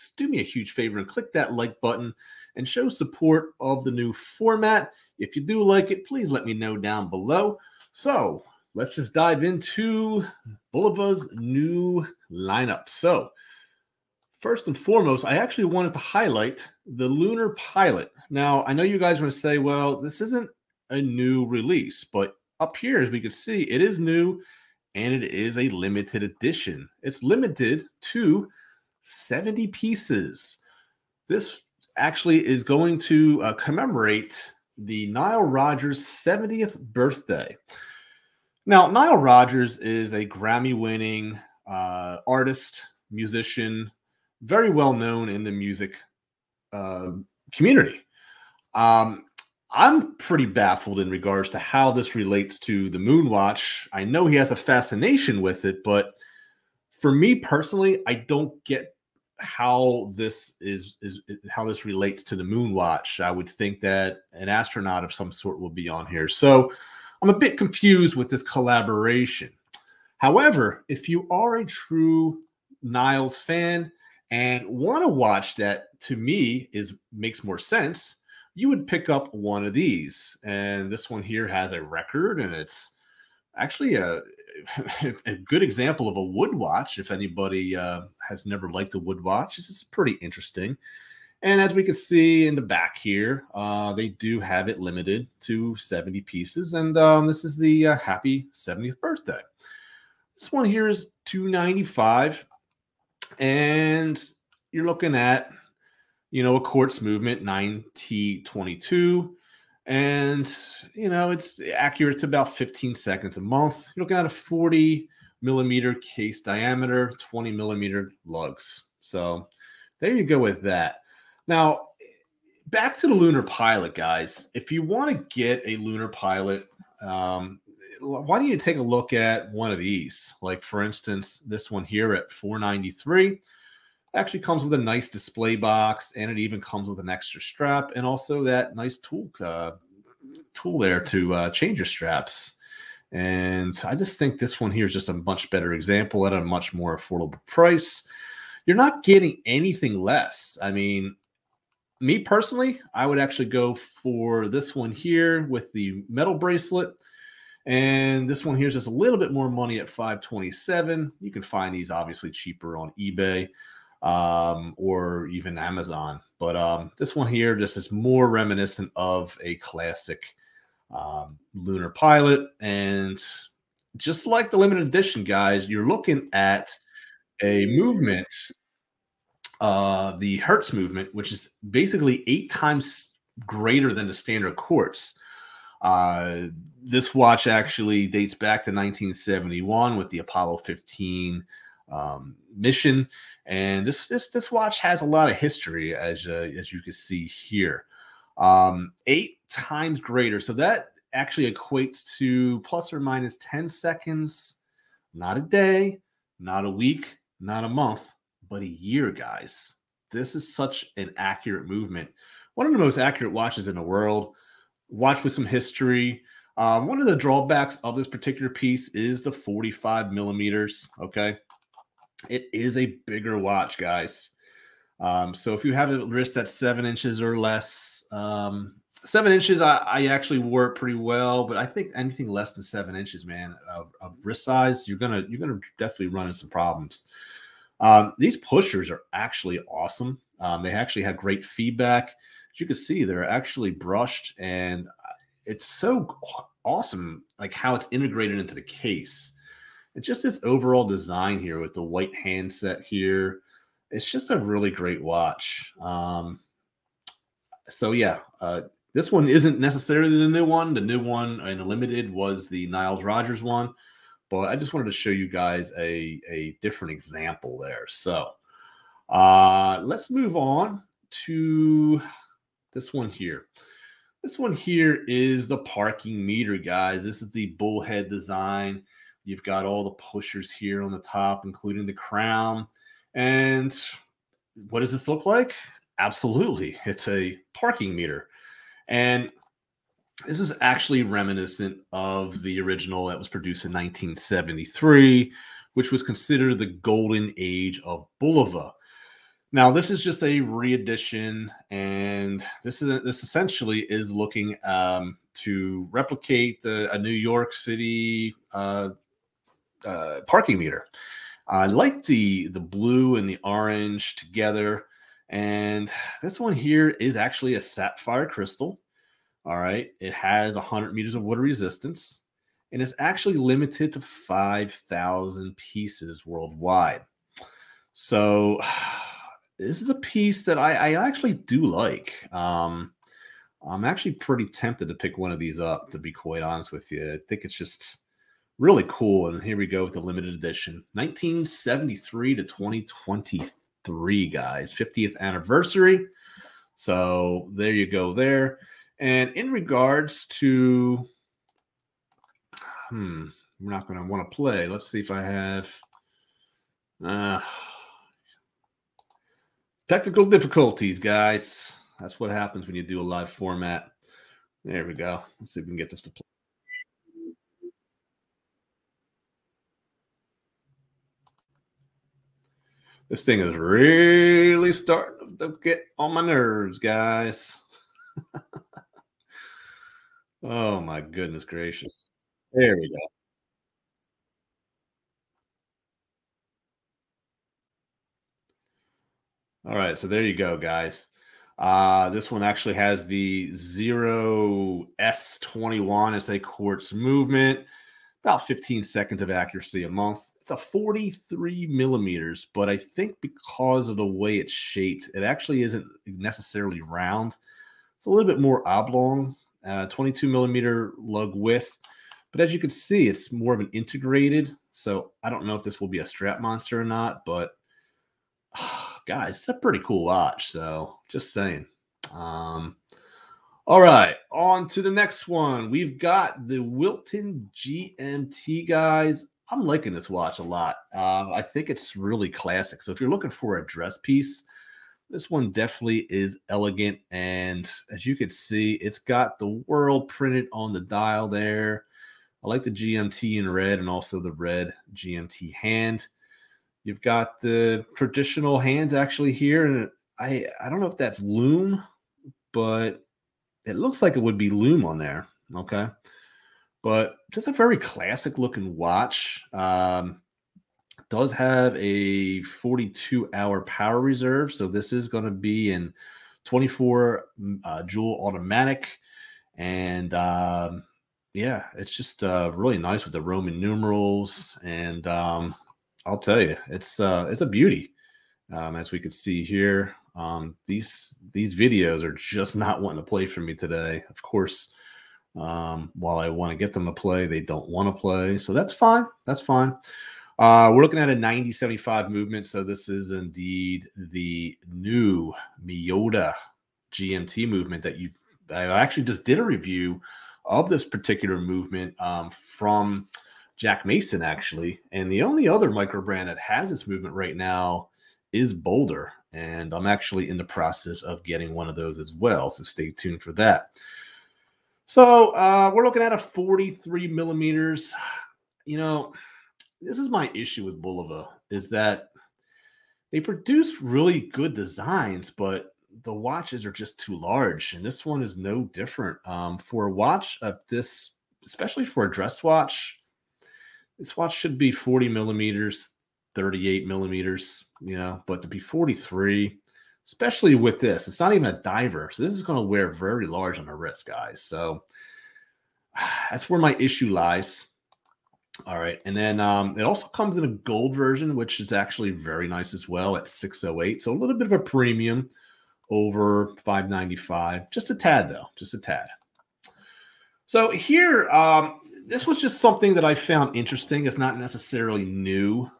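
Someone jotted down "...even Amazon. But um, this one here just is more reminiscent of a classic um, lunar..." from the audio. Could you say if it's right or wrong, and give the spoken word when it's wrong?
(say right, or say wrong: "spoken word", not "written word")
right.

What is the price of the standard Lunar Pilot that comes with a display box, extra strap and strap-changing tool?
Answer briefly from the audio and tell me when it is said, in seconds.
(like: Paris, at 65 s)
493, at 132 s.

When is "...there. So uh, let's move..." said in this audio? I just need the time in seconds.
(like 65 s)
267 s.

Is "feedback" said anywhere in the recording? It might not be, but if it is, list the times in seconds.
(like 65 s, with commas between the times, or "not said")
241 s.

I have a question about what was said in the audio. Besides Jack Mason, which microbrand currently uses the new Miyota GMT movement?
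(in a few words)
Boulder.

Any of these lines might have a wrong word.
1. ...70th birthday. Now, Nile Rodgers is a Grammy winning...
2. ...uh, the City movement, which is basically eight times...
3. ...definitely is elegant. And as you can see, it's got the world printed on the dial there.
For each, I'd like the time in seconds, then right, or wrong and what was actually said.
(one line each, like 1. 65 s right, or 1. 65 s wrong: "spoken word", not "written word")
1. 36 s right
2. 179 s wrong: "Hertz", not "City"
3. 435 s right.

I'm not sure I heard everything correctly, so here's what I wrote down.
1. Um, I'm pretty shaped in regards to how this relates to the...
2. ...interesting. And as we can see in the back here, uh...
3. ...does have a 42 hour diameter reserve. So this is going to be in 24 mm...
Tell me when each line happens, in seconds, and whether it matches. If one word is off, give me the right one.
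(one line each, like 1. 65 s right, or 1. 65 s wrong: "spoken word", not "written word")
1. 48 s wrong: "baffled", not "shaped"
2. 90 s right
3. 461 s wrong: "power", not "diameter".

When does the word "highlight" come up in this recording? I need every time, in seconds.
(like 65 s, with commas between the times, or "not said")
15 s.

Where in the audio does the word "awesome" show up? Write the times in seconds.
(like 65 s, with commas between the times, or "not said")
239 s, 246 s.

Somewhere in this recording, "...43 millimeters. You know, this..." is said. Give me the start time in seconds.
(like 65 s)
516 s.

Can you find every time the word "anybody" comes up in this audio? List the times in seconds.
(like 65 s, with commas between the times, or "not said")
87 s.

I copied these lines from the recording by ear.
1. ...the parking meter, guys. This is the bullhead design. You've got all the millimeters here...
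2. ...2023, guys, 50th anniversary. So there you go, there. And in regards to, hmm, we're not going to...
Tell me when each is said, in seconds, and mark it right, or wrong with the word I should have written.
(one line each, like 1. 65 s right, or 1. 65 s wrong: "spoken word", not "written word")
1. 275 s wrong: "pushers", not "millimeters"
2. 342 s right.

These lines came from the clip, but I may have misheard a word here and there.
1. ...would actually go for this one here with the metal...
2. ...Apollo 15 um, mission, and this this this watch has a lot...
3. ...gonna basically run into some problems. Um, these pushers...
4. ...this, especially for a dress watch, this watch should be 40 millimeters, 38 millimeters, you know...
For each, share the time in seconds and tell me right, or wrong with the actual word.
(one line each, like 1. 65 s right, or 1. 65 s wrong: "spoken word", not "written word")
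1. 153 s right
2. 190 s right
3. 235 s wrong: "definitely", not "basically"
4. 530 s right.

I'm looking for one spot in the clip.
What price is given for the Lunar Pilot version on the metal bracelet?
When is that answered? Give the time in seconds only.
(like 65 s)
159 s.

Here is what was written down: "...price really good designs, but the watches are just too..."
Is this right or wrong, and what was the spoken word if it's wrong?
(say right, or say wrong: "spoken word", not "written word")
wrong: "produce", not "price".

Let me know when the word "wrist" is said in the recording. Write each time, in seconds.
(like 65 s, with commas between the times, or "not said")
226 s, 234 s, 543 s.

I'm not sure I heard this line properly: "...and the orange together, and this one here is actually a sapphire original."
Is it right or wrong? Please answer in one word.
wrong.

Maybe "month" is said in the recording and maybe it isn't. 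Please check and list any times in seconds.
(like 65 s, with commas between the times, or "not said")
113 s, 207 s, 399 s.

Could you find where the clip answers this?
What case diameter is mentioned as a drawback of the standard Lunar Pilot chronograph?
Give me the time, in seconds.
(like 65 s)
219 s.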